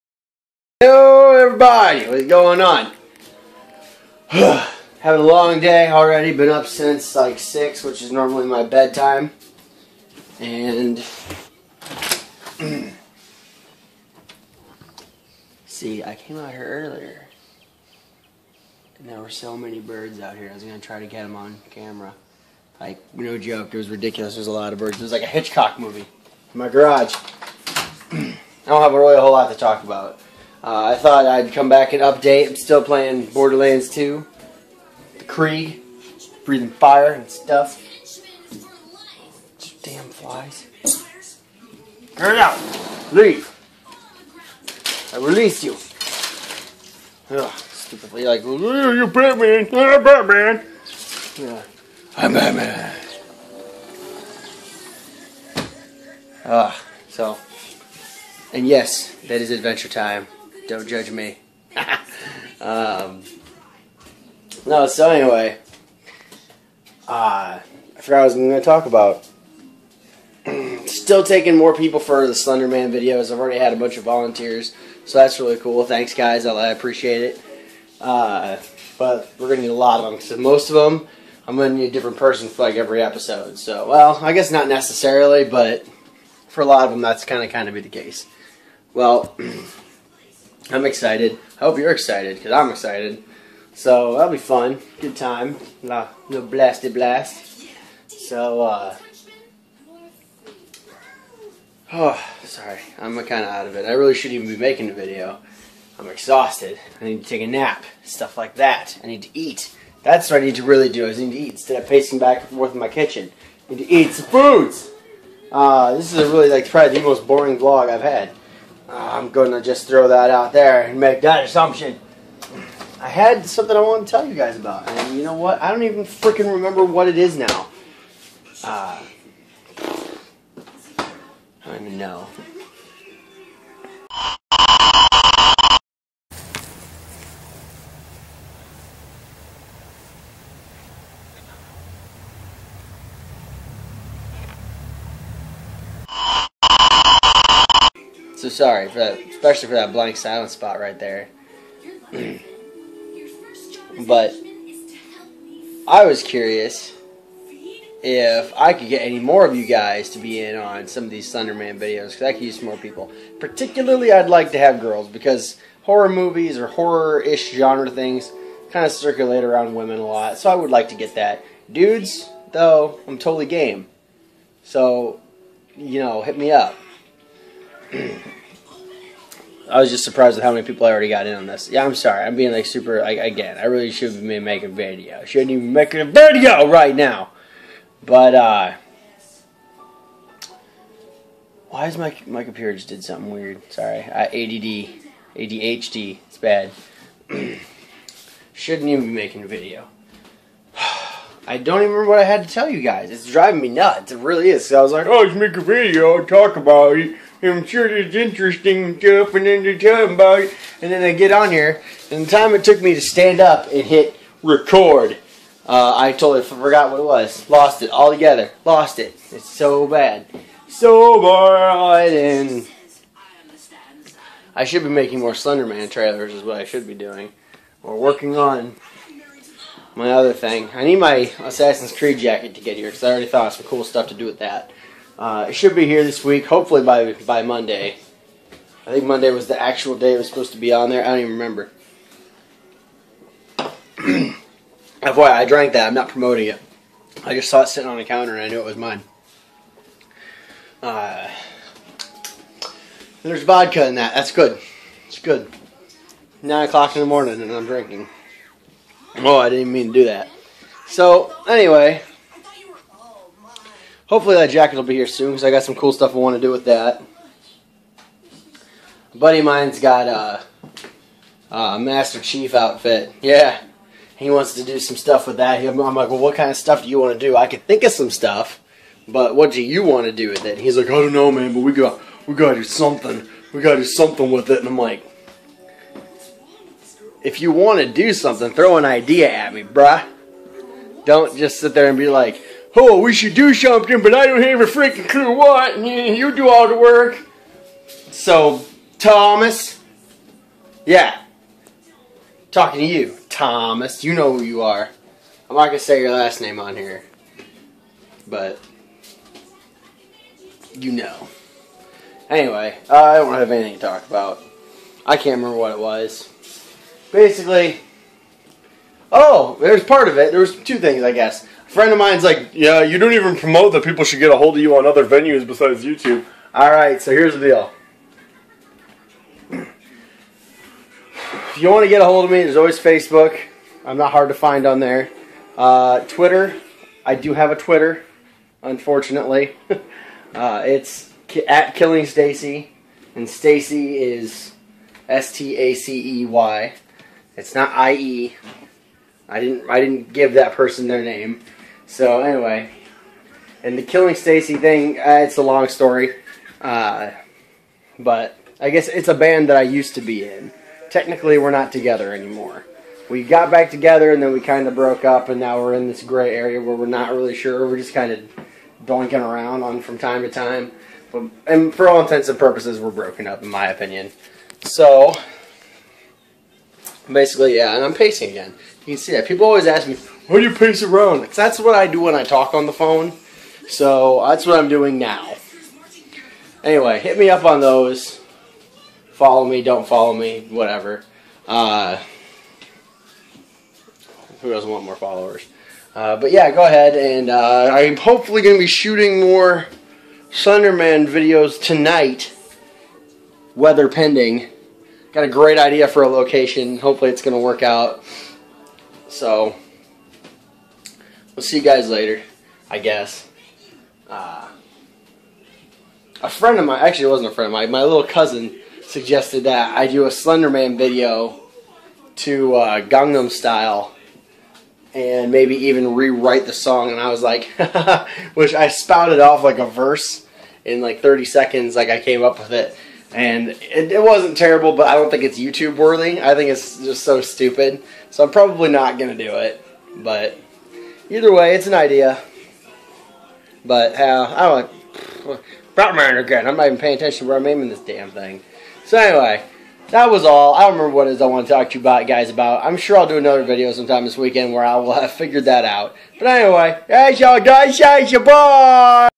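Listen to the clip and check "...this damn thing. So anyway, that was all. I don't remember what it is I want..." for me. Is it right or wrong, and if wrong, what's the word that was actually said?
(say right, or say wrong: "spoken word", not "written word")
right.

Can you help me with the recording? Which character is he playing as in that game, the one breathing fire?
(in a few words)
Krieg.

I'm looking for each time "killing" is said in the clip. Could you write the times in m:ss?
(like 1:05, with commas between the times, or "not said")
5:41, 5:53.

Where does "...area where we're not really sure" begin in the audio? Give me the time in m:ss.
6:06.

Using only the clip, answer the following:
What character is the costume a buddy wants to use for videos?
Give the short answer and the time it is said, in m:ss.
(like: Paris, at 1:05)
Master Chief, at 4:31.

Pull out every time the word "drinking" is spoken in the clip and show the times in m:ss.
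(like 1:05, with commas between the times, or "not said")
4:17.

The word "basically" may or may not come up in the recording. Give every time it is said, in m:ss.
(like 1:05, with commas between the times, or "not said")
5:17, 6:17.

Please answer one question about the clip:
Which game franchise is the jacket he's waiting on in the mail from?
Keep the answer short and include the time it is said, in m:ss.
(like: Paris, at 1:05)
Assassin's Creed, at 3:51.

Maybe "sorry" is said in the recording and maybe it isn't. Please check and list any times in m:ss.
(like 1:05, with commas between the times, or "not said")
1:42, 2:28, 3:01, 3:13.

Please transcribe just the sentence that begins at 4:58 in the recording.
So, Thomas, yeah, talking to you, Thomas.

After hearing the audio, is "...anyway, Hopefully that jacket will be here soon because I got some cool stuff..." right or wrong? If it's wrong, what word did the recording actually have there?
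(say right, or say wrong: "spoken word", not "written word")
right.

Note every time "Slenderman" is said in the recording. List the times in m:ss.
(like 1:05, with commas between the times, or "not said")
1:12, 3:45, 6:40, 7:00.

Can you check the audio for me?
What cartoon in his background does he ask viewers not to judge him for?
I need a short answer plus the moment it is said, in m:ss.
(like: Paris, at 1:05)
Adventure Time, at 0:59.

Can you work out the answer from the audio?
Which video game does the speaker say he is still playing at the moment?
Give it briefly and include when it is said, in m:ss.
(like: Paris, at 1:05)
Borderlands 2, at 0:33.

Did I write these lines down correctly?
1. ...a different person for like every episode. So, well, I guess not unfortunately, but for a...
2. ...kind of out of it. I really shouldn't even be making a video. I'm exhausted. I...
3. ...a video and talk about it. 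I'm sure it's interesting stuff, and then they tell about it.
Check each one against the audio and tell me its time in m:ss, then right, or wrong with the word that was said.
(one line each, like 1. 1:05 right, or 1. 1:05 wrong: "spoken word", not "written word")
1. 1:21 wrong: "necessarily", not "unfortunately"
2. 1:43 right
3. 3:25 right.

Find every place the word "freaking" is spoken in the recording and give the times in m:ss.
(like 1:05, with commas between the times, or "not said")
2:06, 4:54.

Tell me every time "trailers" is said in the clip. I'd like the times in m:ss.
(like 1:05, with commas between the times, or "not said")
3:45.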